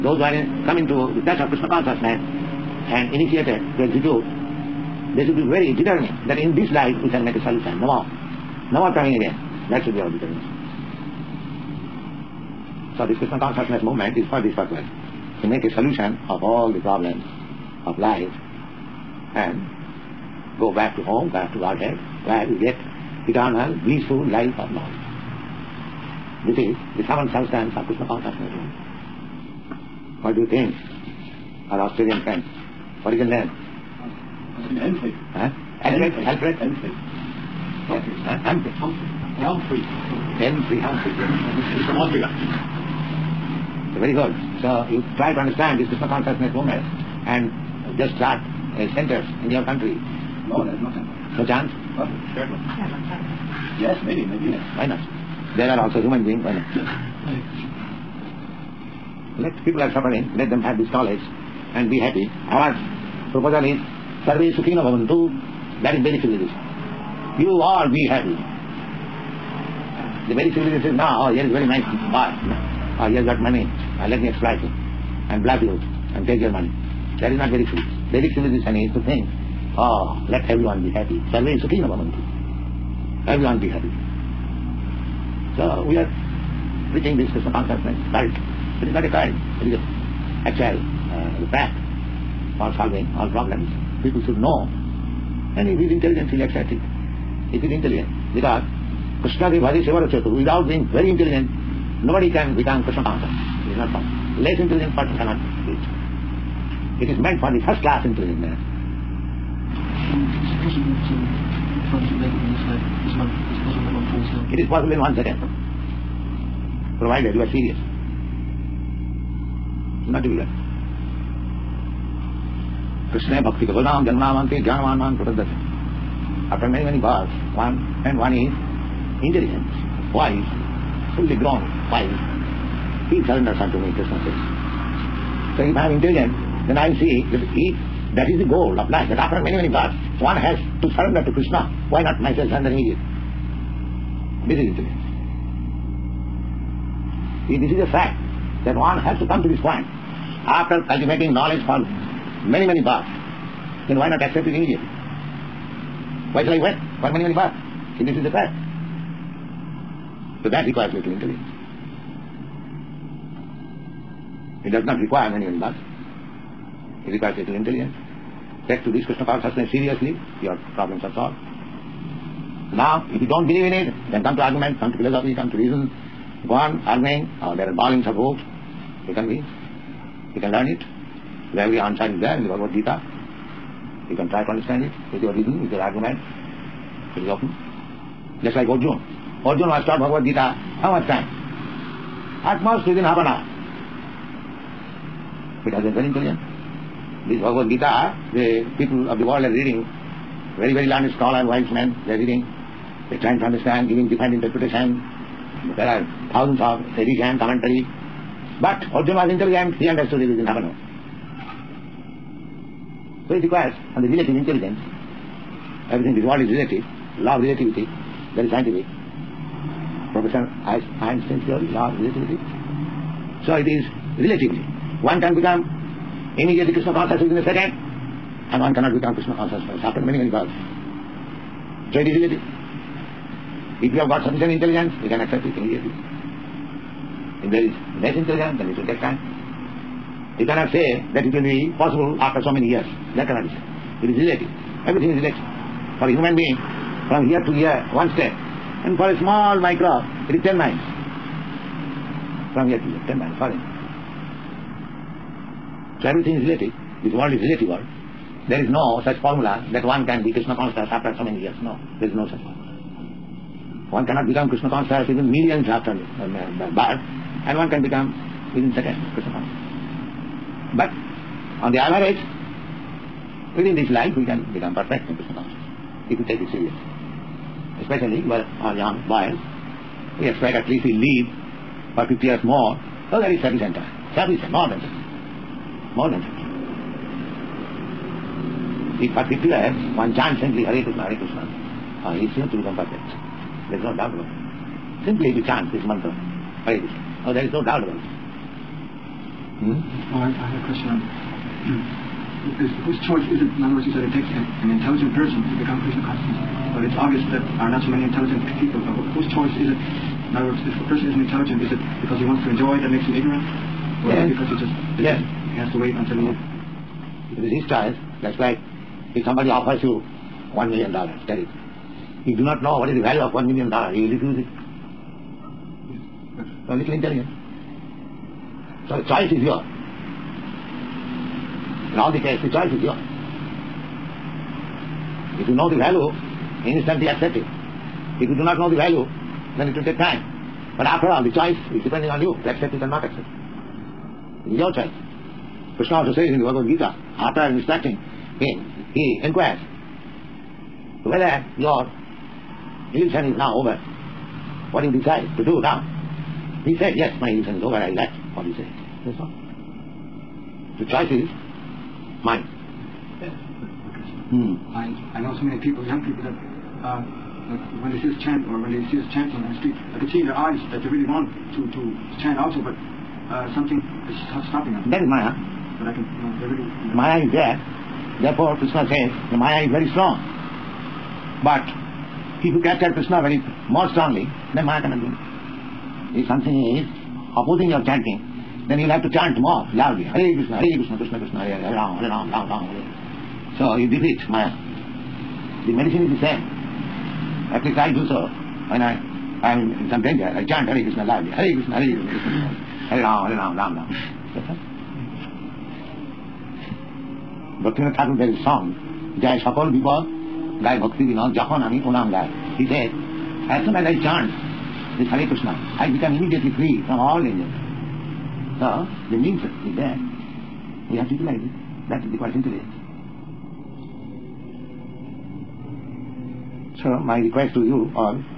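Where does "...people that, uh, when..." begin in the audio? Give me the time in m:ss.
6:06.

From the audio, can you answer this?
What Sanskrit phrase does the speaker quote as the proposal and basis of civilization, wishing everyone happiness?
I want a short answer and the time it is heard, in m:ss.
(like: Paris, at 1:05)
Sarve sukhino Bhavantu, at 1:04.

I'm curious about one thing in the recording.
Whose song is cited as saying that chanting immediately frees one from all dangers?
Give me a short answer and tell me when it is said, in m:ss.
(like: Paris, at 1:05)
Bhaktivinoda Thakur, at 6:47.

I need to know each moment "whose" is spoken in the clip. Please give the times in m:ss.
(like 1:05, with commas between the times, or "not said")
5:02, 5:09.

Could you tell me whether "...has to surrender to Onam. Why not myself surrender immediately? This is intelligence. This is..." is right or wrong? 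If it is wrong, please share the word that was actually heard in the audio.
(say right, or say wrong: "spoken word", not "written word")
wrong: "Krishna", not "Onam".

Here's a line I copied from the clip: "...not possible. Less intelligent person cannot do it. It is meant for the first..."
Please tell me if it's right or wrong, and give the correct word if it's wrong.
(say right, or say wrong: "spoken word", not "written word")
right.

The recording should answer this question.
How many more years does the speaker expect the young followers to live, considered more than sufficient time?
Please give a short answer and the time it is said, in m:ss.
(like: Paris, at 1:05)
50, at 4:42.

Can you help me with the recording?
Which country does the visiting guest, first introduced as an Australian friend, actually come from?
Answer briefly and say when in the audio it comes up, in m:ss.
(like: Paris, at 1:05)
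Austria, at 0:41.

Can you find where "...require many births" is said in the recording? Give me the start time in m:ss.
2:44.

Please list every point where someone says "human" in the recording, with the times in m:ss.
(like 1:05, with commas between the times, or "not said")
0:56, 4:06.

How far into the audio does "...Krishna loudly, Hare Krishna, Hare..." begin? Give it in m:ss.
6:40.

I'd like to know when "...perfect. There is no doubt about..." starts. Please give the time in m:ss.
4:52.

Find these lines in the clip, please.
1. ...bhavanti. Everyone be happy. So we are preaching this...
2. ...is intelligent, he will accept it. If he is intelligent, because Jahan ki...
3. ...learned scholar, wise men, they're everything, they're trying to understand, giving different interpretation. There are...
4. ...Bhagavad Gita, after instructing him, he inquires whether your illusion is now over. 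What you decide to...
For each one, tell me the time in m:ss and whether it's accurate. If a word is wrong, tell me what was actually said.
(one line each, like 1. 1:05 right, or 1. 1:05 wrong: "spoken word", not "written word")
1. 1:21 right
2. 1:35 wrong: "Krishna", not "Jahan"
3. 3:20 wrong: "reading", not "everything"
4. 5:46 right.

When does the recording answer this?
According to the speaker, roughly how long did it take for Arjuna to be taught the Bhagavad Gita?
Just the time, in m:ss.
3:13.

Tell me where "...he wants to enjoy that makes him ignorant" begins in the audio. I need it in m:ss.
5:12.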